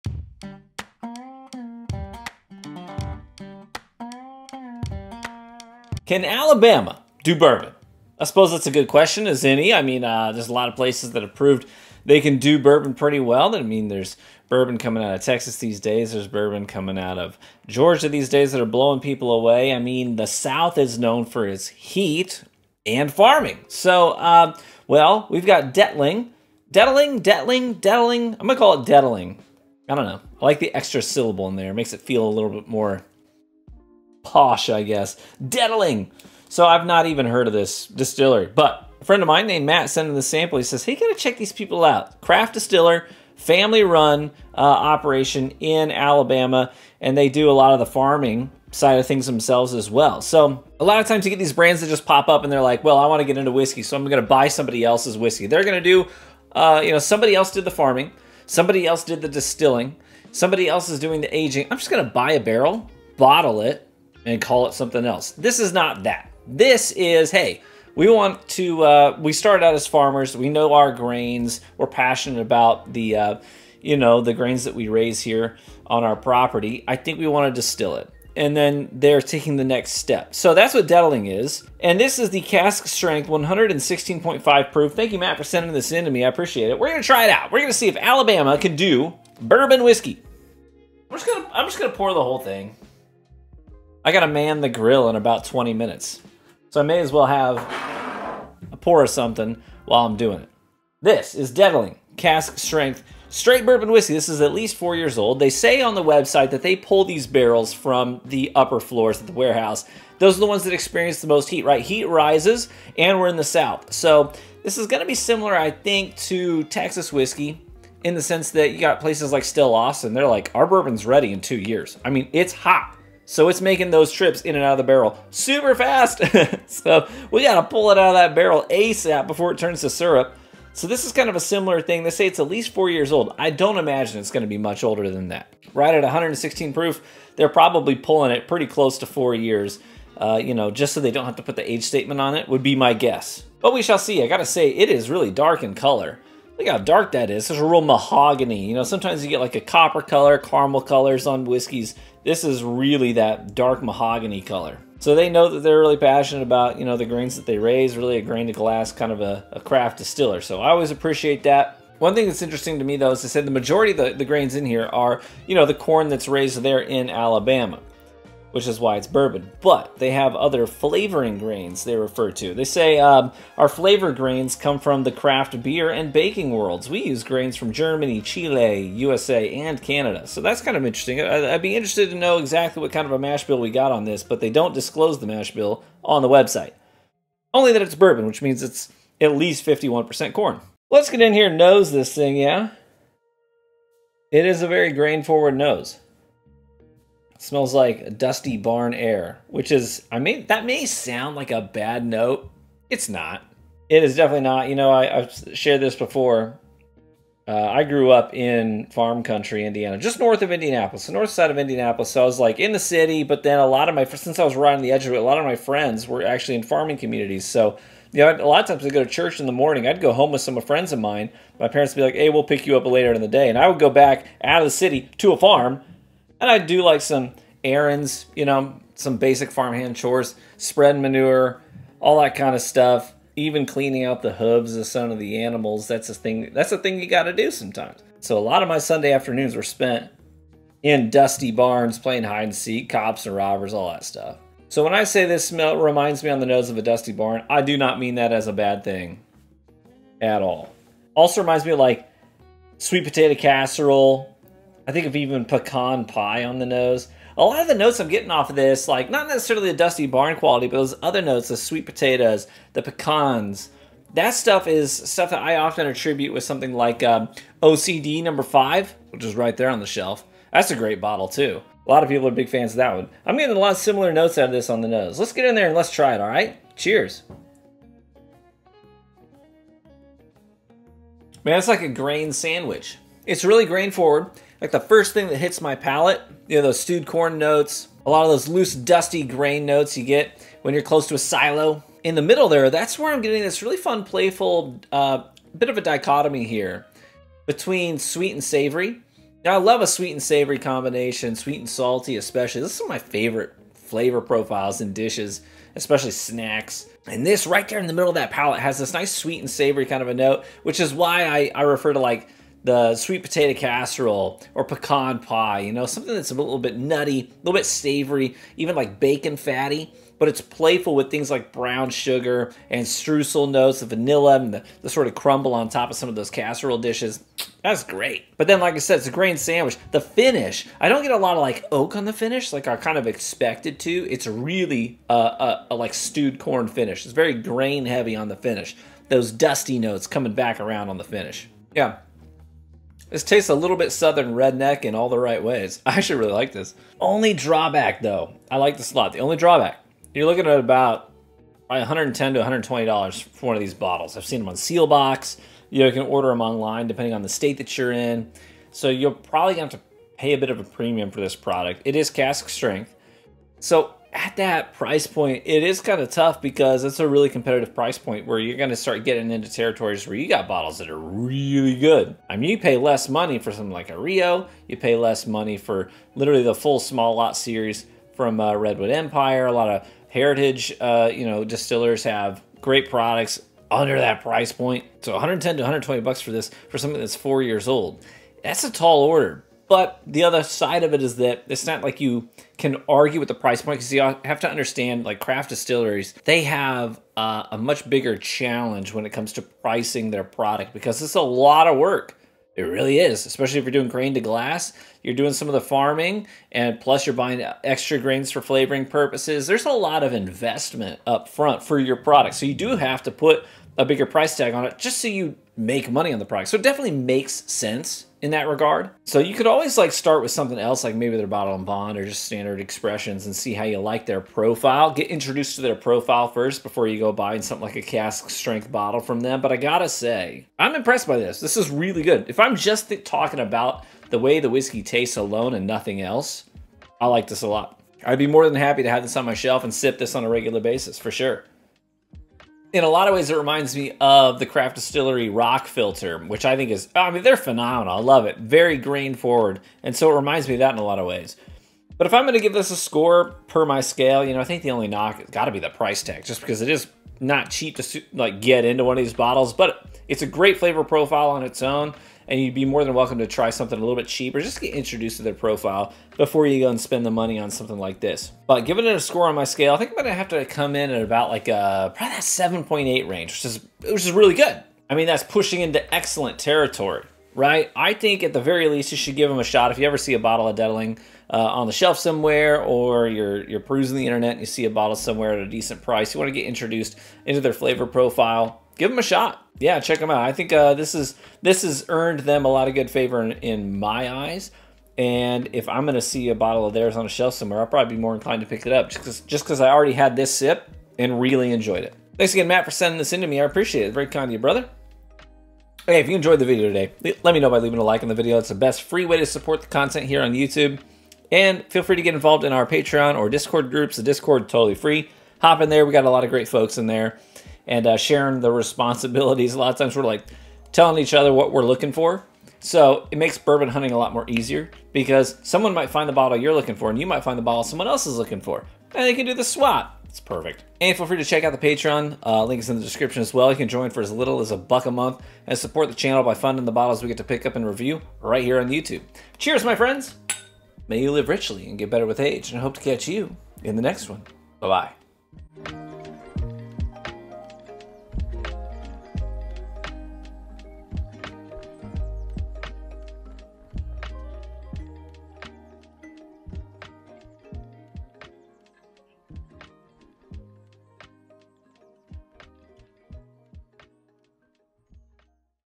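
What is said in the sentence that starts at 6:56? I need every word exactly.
So it definitely makes sense in that regard.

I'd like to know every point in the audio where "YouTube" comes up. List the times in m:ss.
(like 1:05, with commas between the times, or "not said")
8:30, 8:58.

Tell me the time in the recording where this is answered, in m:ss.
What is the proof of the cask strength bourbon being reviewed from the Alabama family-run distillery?
1:23.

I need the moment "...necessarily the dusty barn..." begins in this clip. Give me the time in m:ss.
4:19.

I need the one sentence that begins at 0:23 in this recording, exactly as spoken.
So, uh, well, we've got Dettling.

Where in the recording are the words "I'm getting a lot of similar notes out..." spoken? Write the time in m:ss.
4:33.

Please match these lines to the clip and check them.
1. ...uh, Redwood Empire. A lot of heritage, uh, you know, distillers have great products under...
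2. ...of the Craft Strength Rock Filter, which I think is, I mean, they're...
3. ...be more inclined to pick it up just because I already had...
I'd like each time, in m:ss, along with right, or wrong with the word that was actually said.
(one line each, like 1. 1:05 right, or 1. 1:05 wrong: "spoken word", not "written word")
1. 6:18 right
2. 7:23 wrong: "Distillery", not "Strength"
3. 8:17 right.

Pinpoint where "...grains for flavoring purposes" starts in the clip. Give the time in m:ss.
6:47.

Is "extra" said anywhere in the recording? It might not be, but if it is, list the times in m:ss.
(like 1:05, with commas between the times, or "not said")
0:30, 6:47.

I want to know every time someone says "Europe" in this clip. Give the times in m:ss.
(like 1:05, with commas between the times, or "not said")
not said.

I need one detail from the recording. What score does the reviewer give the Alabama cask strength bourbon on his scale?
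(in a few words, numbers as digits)
7.8.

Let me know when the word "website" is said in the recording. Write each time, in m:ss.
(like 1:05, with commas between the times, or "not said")
1:46, 3:06.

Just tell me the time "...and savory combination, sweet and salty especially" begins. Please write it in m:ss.
5:00.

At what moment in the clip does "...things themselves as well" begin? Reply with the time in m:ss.
0:49.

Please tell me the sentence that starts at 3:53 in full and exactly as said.
Even cleaning out the hooves of some of the animals.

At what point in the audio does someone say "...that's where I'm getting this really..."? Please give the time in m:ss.
4:52.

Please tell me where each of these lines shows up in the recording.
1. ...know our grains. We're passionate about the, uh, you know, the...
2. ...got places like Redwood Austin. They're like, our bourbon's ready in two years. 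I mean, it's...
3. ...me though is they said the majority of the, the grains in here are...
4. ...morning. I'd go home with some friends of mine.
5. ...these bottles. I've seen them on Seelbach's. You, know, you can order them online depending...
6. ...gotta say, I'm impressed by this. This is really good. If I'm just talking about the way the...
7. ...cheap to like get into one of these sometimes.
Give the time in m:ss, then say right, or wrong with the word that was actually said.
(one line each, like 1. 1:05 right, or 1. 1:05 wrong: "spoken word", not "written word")
1. 1:10 right
2. 1:58 wrong: "Still", not "Redwood"
3. 2:42 right
4. 3:39 right
5. 5:53 right
6. 7:09 right
7. 7:37 wrong: "bottles", not "sometimes".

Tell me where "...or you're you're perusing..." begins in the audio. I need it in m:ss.
8:02.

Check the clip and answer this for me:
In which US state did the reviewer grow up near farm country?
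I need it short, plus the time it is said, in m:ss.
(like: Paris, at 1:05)
Indiana, at 3:29.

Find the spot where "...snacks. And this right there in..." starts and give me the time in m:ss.
5:06.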